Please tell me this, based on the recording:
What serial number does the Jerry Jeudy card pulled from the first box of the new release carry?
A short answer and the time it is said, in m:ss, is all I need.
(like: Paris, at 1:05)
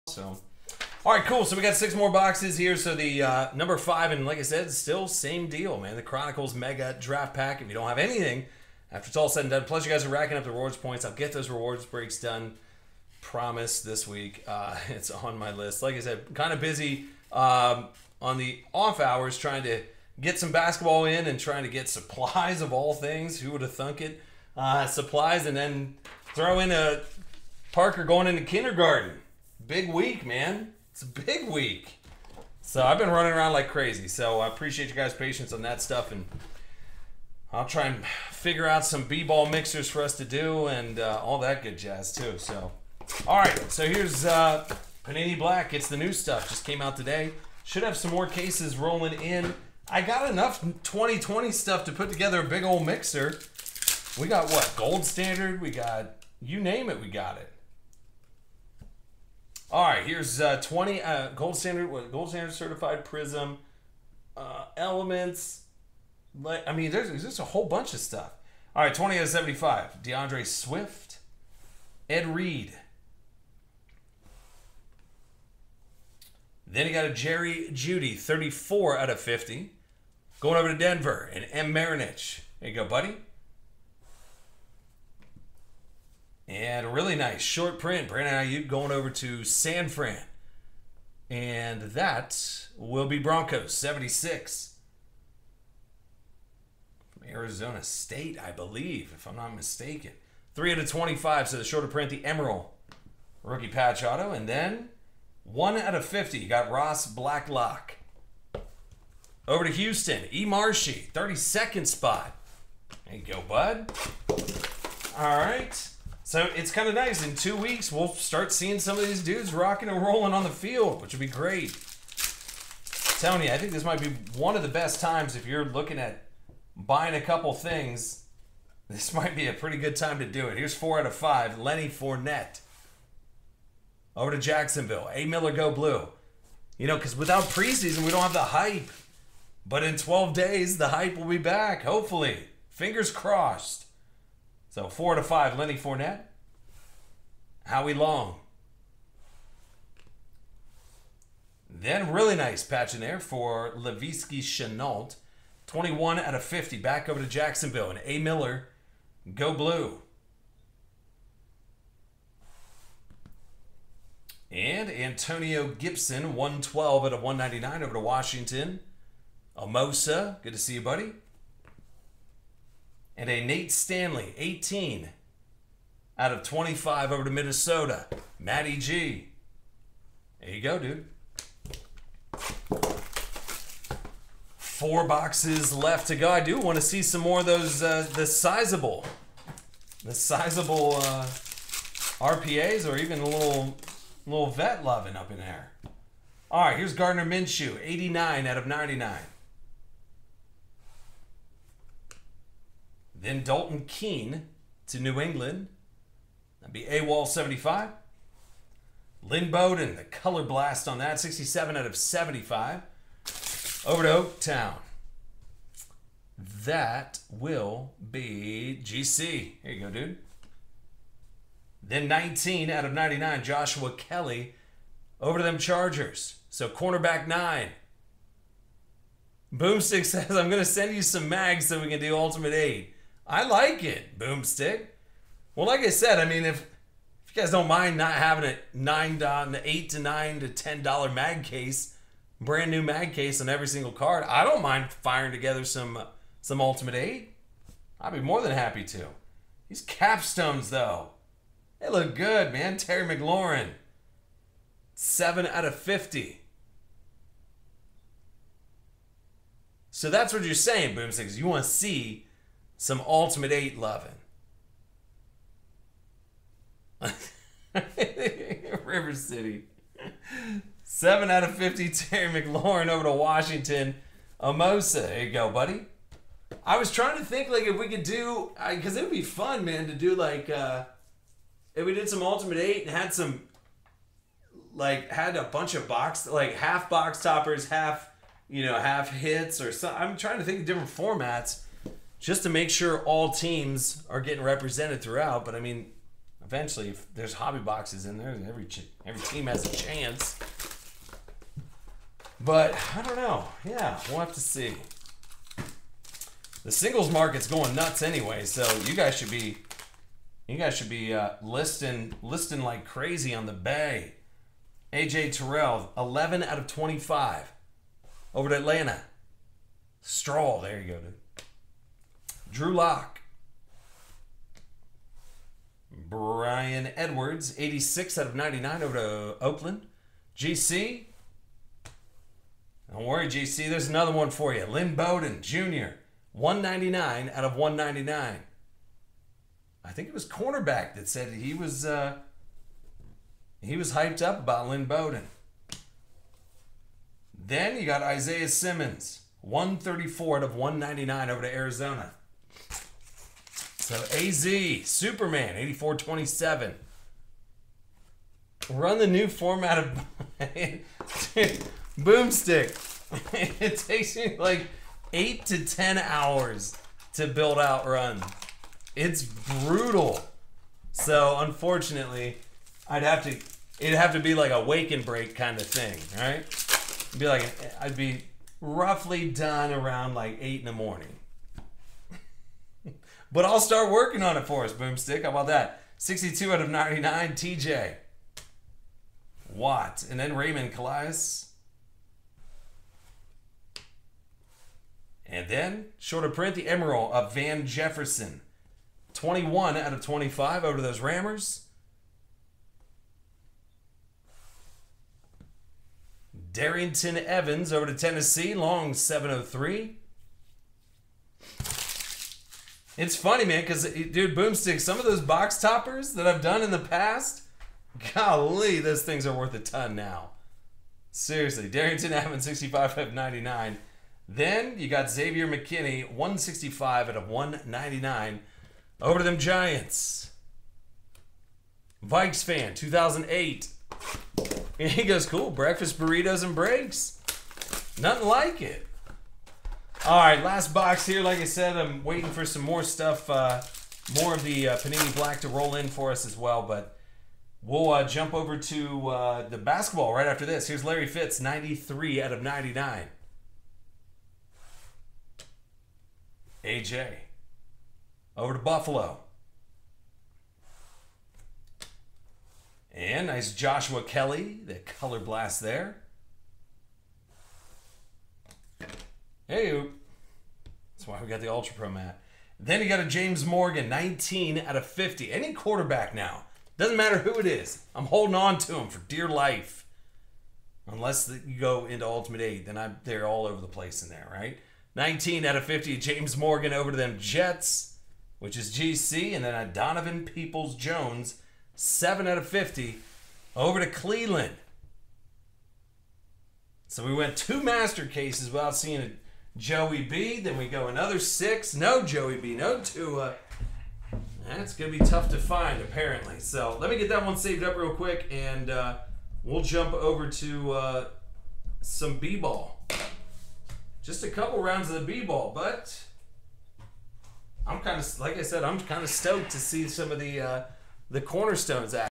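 34 out of 50, at 1:18.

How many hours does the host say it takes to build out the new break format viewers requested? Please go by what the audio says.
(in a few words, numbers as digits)
8 to 10.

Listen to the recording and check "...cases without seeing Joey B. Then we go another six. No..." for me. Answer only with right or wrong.
right.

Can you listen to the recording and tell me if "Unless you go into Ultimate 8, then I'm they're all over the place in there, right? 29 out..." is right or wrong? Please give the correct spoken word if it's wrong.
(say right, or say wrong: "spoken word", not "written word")
wrong: "19", not "29".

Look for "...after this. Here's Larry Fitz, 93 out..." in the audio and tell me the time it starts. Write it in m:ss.
7:30.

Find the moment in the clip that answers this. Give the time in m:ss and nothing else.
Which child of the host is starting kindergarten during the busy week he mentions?
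0:27.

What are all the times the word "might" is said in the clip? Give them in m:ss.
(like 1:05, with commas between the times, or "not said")
2:03, 2:09.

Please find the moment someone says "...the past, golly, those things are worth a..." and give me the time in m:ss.
6:56.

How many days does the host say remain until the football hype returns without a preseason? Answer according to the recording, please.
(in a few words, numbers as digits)
12.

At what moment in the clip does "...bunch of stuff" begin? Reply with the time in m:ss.
1:07.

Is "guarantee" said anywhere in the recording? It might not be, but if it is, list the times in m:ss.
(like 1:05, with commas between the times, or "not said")
not said.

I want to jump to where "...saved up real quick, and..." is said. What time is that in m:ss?
8:27.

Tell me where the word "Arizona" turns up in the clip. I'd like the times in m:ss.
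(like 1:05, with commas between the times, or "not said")
1:37, 5:51.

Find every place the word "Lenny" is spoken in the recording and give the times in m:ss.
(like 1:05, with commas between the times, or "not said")
2:11, 2:25.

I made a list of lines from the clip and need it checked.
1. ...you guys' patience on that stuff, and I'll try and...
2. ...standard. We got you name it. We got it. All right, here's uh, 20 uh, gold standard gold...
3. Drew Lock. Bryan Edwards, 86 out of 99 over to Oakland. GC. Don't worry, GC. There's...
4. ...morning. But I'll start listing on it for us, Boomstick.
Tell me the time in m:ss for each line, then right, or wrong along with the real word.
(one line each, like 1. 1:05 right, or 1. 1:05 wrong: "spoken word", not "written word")
1. 0:34 right
2. 0:55 right
3. 5:22 right
4. 6:20 wrong: "working", not "listing".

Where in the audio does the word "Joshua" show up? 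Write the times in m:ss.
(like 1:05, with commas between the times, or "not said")
3:43, 7:43.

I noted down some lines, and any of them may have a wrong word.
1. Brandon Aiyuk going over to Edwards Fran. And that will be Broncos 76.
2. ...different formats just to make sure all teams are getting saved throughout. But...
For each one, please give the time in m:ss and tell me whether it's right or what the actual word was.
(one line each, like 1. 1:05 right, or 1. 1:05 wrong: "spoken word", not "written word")
1. 1:28 wrong: "San", not "Edwards"
2. 4:50 wrong: "represented", not "saved".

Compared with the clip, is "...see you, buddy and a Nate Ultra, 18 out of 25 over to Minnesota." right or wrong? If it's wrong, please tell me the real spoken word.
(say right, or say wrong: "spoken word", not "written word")
wrong: "Stanley", not "Ultra".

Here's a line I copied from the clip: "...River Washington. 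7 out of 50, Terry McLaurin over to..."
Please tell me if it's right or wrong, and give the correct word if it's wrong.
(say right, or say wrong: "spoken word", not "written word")
wrong: "City", not "Washington".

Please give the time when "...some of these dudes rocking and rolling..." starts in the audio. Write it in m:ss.
1:58.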